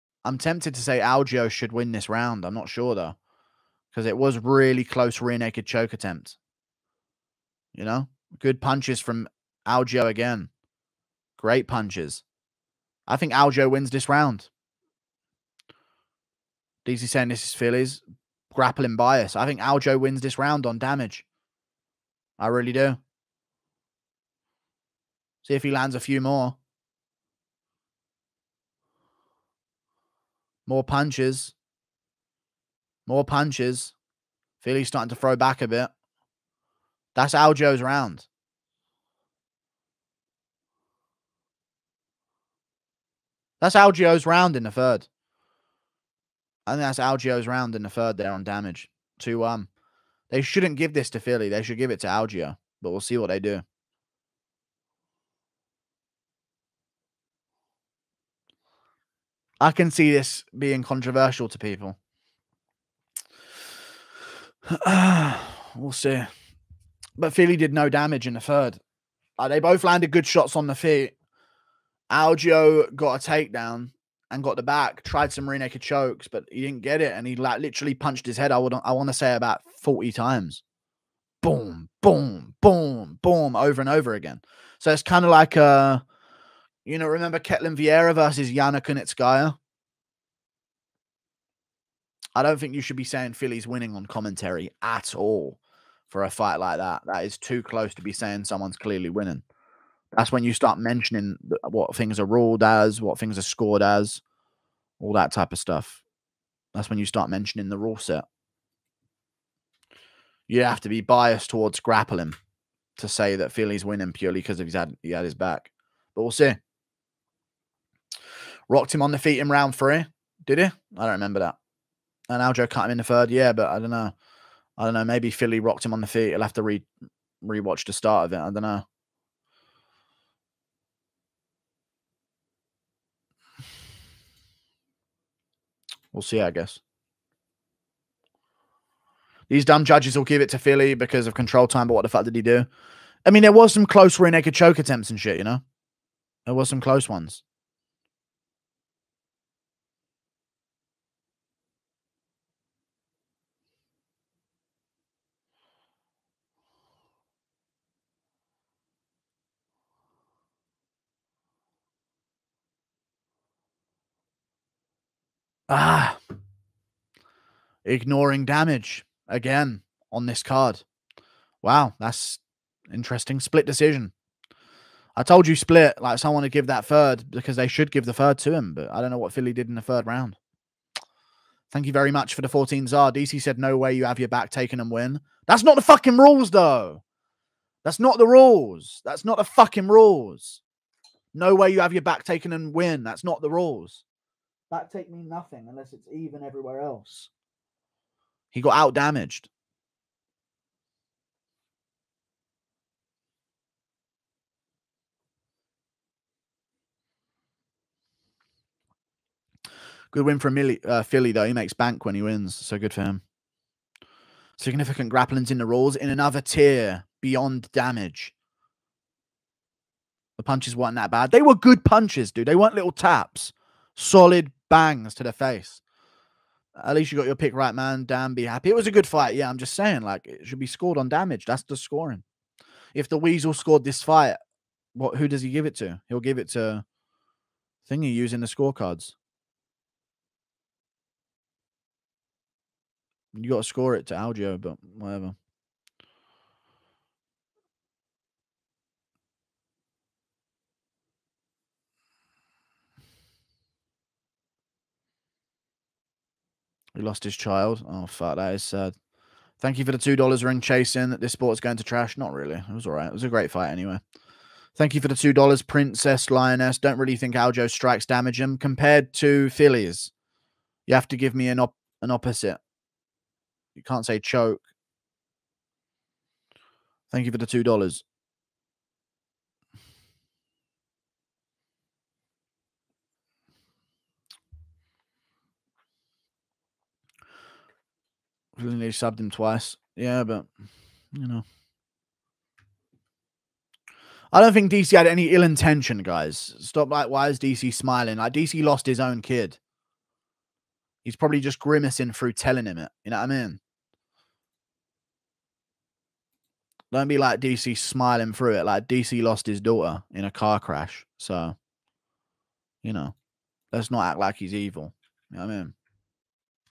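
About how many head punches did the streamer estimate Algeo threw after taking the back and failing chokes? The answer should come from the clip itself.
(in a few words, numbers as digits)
40.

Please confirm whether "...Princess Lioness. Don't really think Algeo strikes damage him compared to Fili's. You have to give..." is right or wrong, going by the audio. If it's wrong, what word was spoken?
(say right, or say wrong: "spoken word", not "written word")
right.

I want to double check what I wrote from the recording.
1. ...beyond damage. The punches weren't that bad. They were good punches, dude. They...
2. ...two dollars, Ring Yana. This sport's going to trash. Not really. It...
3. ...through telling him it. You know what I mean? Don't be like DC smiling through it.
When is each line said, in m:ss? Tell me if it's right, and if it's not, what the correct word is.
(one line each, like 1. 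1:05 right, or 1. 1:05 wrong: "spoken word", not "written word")
1. 3:37 right
2. 4:19 wrong: "Chasing", not "Yana"
3. 5:02 right.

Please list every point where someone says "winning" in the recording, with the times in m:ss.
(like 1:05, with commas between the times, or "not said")
1:33, 1:39, 1:53.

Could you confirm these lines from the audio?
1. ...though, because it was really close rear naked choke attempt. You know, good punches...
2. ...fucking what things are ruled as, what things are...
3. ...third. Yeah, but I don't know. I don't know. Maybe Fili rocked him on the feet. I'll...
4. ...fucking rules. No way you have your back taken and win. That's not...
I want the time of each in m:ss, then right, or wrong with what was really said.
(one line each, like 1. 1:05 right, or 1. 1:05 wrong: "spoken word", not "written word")
1. 0:02 right
2. 1:40 wrong: "mentioning", not "fucking"
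3. 2:03 right
4. 3:09 right.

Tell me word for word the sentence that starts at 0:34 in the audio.
Fili's starting to throw back a bit.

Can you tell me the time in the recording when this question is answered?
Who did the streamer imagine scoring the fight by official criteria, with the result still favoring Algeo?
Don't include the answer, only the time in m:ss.
3:53.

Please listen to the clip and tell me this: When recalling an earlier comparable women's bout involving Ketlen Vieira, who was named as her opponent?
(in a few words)
Yana Kunitskaya.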